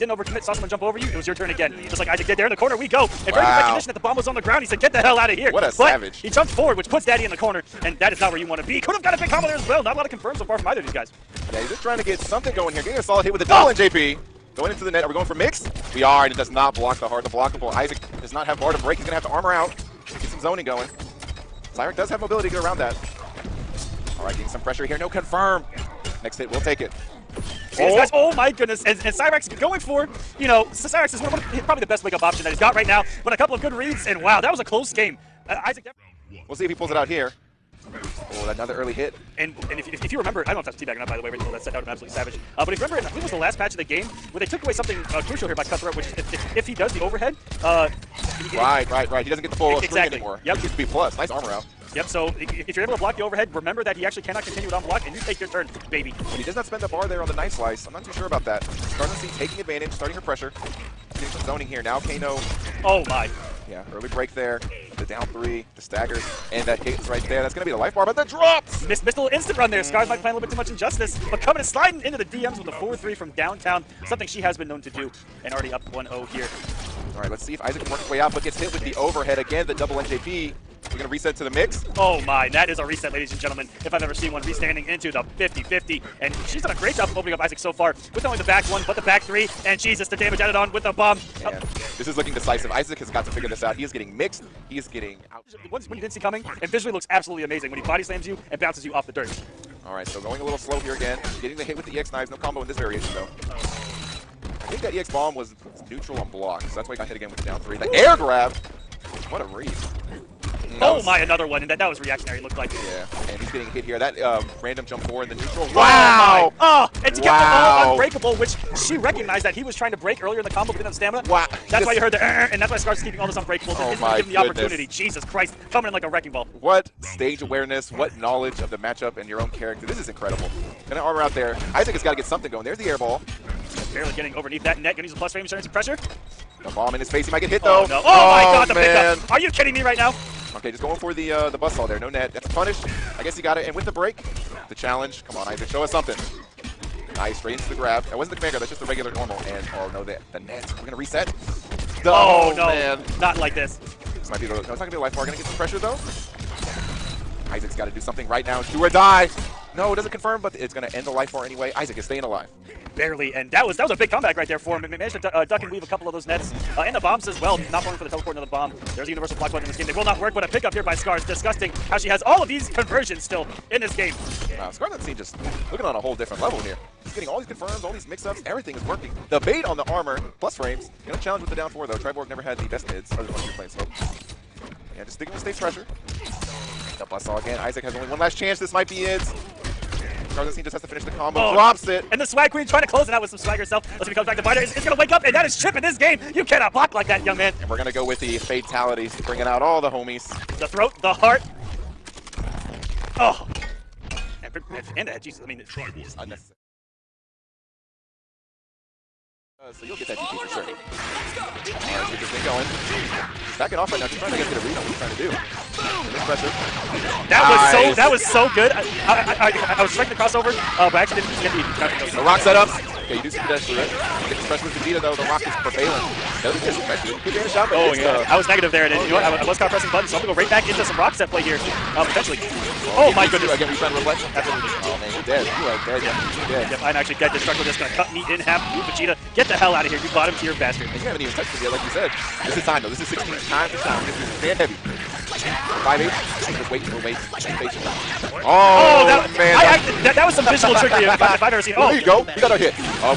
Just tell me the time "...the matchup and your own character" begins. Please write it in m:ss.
2:08.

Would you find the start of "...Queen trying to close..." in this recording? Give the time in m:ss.
3:12.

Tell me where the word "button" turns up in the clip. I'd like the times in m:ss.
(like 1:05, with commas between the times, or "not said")
2:49, 3:49.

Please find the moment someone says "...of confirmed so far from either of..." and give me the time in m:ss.
0:10.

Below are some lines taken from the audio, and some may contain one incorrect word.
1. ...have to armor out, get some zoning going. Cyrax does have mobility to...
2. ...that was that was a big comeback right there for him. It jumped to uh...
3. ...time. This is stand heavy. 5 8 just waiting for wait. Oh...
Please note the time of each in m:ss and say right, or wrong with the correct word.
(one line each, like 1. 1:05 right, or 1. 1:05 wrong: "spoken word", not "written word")
1. 0:19 right
2. 2:43 wrong: "managed", not "jumped"
3. 4:03 right.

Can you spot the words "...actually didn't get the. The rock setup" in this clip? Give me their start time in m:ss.
3:41.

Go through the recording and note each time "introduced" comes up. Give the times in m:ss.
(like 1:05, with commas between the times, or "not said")
not said.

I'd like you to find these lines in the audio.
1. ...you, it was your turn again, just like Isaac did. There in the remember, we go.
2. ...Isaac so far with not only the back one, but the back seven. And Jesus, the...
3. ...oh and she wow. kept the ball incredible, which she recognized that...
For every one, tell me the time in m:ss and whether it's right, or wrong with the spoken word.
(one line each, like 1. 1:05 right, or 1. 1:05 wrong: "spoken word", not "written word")
1. 0:00 wrong: "corner", not "remember"
2. 1:27 wrong: "three", not "seven"
3. 1:56 wrong: "unbreakable", not "incredible".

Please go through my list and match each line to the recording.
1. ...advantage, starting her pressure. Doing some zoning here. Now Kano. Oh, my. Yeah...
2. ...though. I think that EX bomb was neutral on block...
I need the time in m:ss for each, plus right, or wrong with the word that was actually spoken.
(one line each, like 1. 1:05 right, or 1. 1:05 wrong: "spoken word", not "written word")
1. 0:59 right
2. 1:43 right.